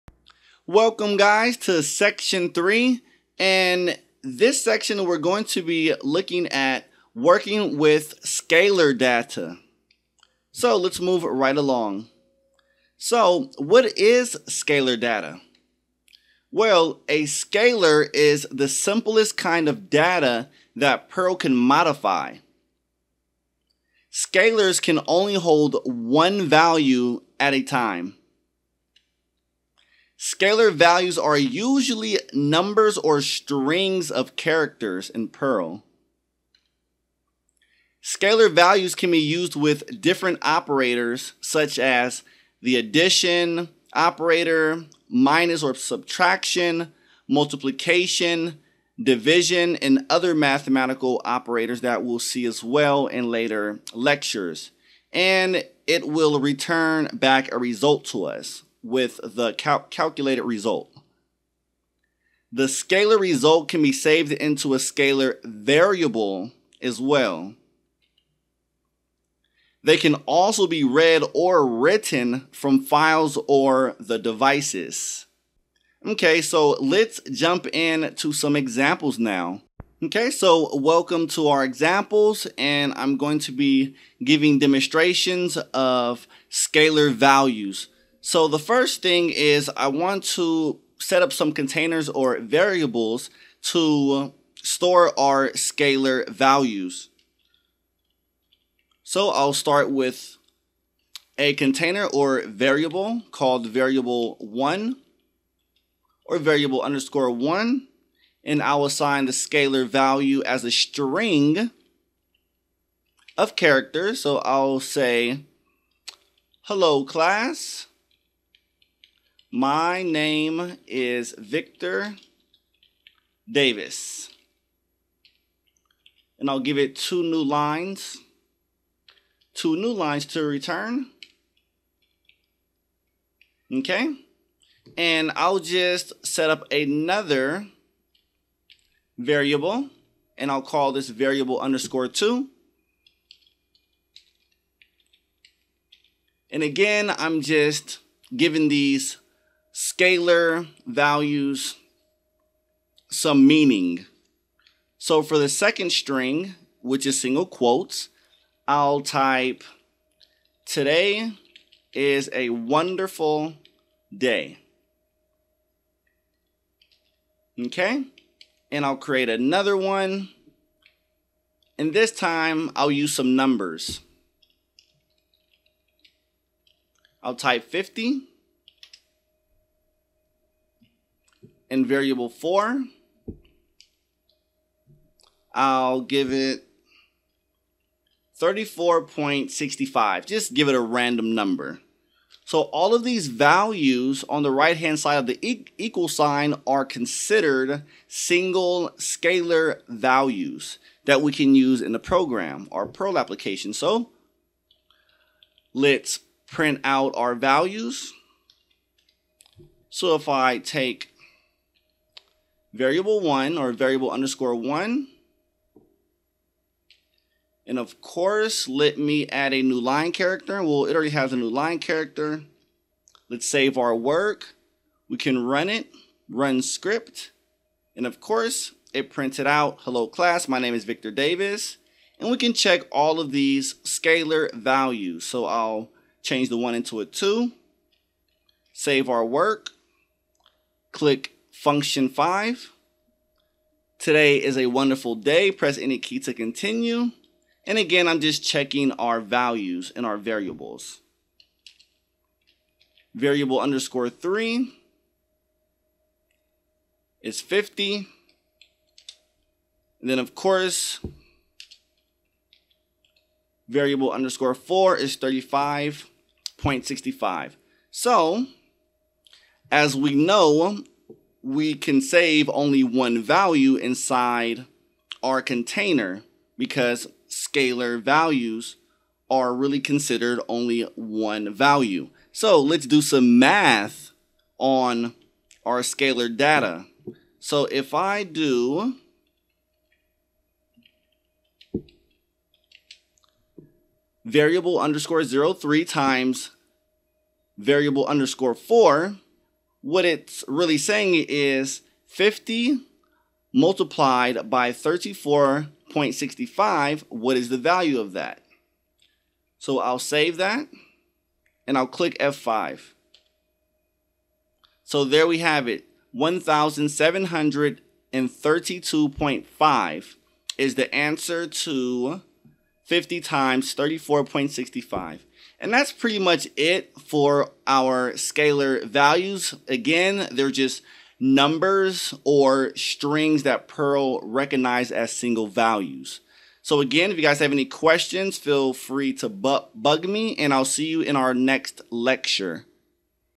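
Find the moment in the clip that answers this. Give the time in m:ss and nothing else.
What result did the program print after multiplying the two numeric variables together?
5:16.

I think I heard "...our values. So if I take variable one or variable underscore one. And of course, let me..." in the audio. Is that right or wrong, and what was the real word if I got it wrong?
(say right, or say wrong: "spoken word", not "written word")
right.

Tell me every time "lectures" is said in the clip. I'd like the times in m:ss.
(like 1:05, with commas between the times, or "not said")
0:53, 5:41.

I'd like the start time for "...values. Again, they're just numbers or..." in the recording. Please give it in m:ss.
5:28.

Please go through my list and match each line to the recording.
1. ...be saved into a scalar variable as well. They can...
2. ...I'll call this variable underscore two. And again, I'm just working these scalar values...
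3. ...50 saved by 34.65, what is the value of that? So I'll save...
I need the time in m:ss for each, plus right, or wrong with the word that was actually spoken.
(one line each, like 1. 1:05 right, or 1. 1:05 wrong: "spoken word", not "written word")
1. 1:03 right
2. 2:20 wrong: "giving", not "working"
3. 5:02 wrong: "multiplied", not "saved".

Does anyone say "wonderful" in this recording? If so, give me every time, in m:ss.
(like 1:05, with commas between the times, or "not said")
2:42, 4:04.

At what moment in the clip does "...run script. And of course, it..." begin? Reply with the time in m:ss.
3:46.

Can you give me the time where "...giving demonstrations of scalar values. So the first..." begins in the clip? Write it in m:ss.
1:24.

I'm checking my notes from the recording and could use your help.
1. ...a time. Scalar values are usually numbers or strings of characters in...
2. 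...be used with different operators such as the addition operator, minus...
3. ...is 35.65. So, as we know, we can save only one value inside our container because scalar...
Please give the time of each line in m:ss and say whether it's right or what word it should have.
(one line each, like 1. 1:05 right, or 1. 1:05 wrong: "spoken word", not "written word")
1. 0:27 right
2. 0:39 right
3. 4:24 right.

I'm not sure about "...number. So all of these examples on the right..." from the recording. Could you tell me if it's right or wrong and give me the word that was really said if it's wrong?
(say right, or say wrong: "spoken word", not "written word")
wrong: "values", not "examples".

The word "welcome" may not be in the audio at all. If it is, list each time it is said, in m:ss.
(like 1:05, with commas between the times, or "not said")
0:00, 1:20.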